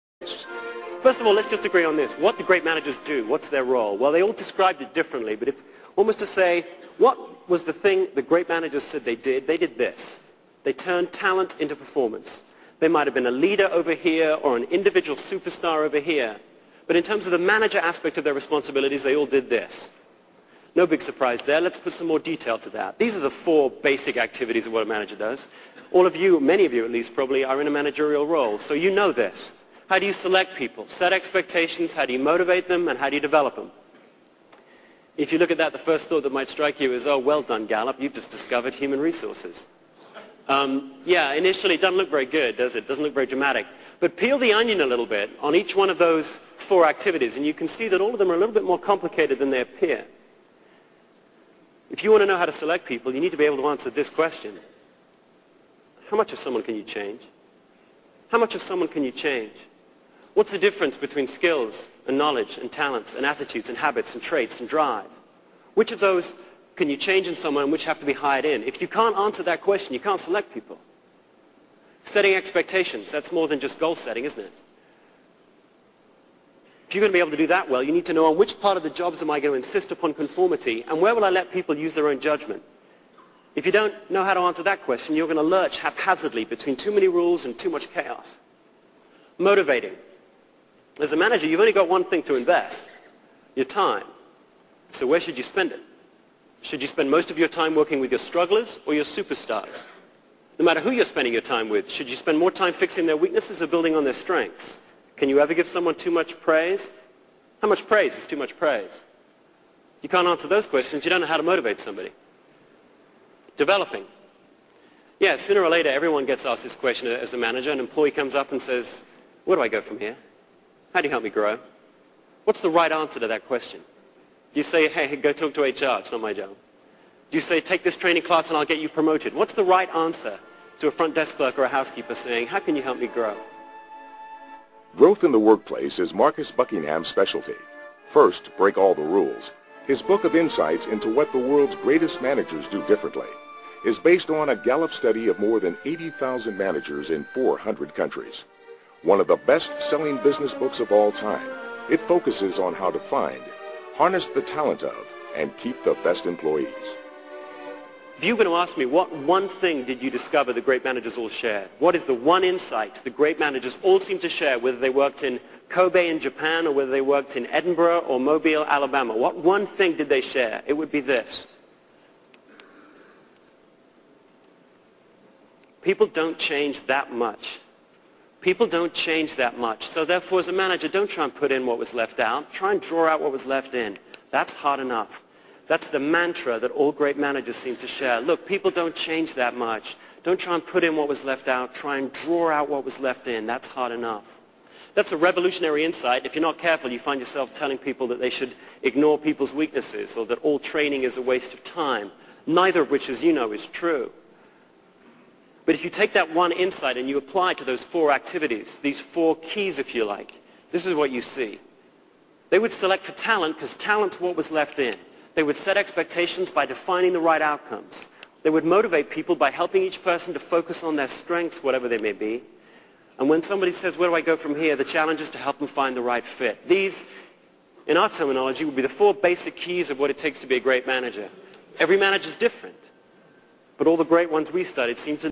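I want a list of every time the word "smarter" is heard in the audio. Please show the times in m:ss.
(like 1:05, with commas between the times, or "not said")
not said.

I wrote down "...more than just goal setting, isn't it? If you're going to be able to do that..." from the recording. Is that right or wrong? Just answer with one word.
right.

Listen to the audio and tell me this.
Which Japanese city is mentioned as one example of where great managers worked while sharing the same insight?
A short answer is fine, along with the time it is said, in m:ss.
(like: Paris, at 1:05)
Kobe, at 2:45.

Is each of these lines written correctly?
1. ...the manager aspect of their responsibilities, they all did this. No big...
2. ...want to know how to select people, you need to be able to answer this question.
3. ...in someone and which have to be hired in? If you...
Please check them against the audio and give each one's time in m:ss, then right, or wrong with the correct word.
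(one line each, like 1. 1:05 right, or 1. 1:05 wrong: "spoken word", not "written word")
1. 0:17 right
2. 0:52 right
3. 1:07 right.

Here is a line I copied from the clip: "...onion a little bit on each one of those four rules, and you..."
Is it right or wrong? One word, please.
wrong.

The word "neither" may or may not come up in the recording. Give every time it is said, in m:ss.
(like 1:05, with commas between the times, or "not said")
3:22.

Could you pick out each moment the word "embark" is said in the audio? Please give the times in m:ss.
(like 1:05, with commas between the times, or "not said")
not said.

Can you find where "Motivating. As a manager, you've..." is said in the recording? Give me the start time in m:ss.
1:29.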